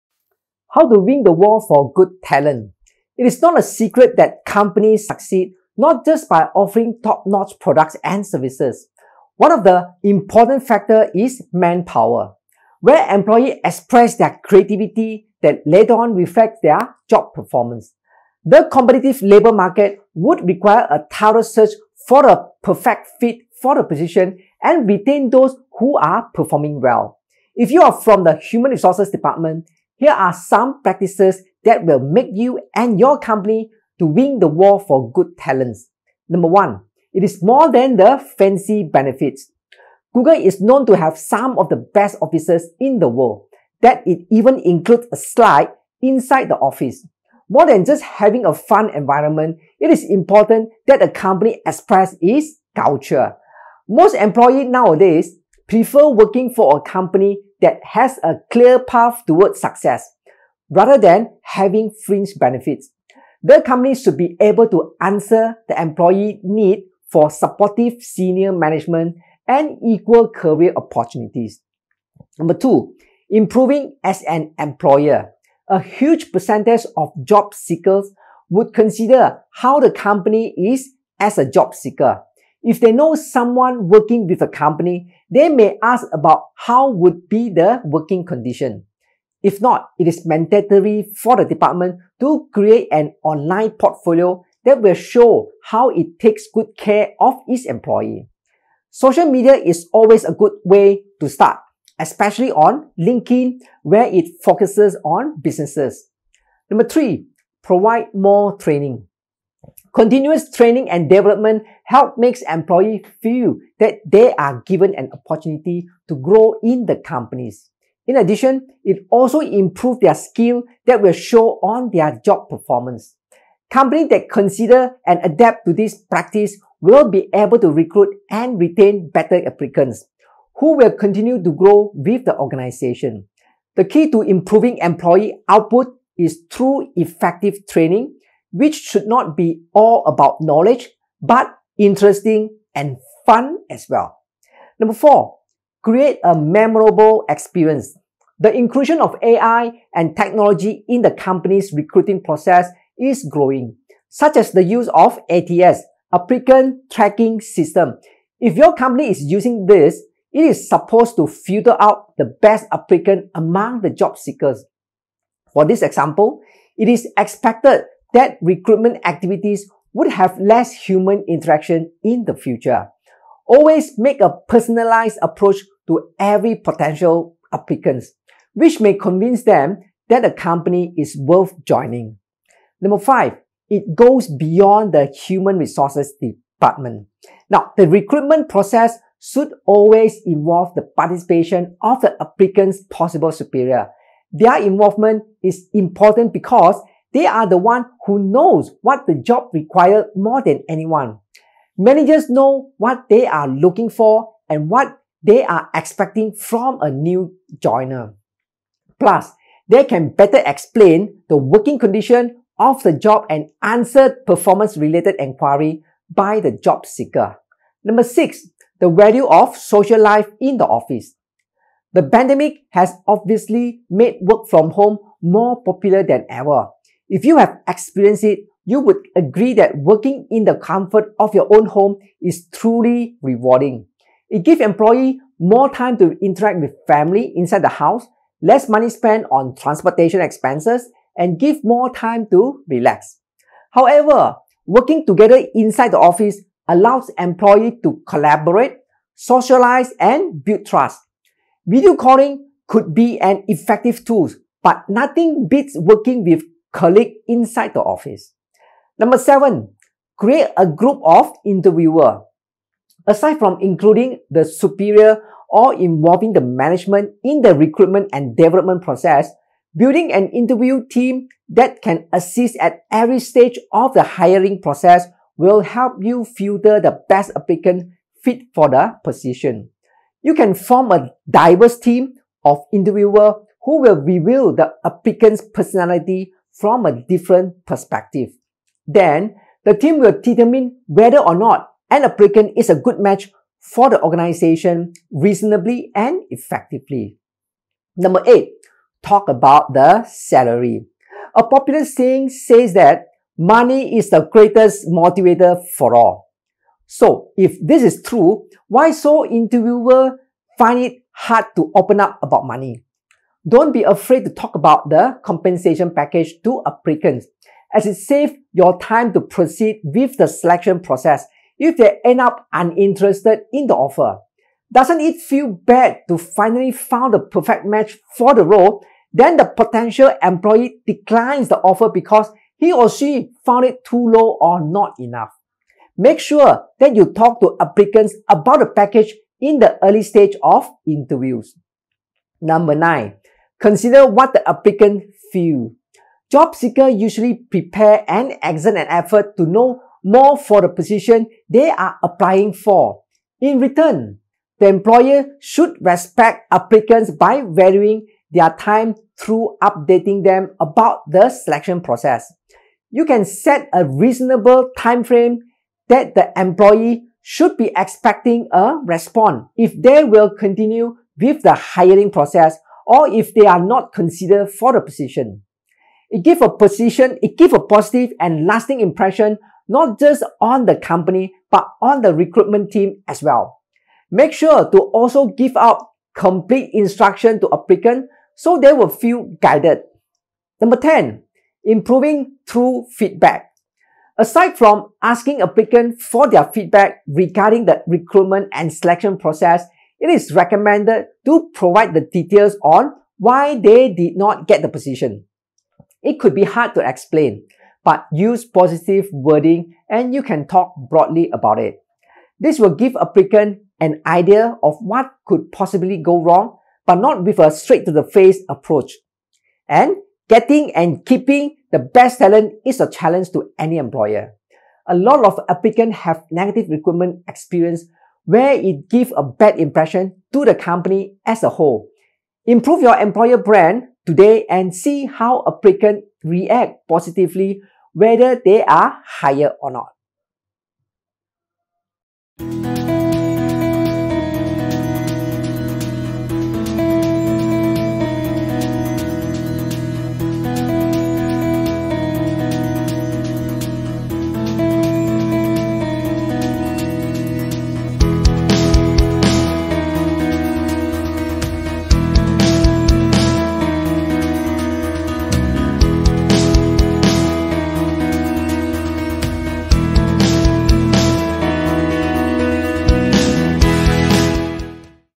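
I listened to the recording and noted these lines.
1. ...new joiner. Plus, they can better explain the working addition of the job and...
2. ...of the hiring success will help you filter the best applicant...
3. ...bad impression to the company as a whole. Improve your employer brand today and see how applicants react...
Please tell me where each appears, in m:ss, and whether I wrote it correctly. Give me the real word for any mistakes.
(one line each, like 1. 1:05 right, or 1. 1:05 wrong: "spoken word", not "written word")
1. 3:26 wrong: "condition", not "addition"
2. 4:33 wrong: "process", not "success"
3. 7:09 right.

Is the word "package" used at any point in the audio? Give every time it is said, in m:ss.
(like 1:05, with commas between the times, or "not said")
5:15, 5:38.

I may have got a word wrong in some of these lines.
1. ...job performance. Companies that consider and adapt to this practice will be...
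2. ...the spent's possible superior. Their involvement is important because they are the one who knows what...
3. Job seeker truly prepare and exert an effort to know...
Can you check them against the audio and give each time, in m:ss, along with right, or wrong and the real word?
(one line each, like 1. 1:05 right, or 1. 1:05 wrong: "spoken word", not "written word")
1. 2:02 right
2. 3:12 wrong: "applicant", not "spent"
3. 5:46 wrong: "usually", not "truly".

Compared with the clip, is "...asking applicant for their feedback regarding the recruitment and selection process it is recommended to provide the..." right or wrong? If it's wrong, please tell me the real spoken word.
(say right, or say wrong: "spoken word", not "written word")
right.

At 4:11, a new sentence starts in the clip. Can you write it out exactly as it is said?
Video calling could be an effective tool, but nothing beats working with colleague inside the office.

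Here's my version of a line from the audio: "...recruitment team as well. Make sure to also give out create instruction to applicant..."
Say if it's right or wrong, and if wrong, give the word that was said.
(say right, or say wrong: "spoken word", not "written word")
wrong: "complete", not "create".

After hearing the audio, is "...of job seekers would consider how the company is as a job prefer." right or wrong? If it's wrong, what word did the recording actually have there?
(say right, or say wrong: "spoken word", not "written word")
wrong: "seeker", not "prefer".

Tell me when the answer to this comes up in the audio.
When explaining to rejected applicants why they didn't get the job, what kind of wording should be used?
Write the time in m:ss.
6:48.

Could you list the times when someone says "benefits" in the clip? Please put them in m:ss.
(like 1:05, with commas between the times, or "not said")
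0:38, 1:02.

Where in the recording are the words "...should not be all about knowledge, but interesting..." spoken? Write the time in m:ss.
2:18.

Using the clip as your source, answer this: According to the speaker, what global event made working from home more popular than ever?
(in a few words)
The pandemic.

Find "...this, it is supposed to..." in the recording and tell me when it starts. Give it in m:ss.
2:39.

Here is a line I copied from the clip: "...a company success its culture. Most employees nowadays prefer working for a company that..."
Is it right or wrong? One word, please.
wrong.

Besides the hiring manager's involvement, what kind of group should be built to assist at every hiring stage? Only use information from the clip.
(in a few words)
An interview team.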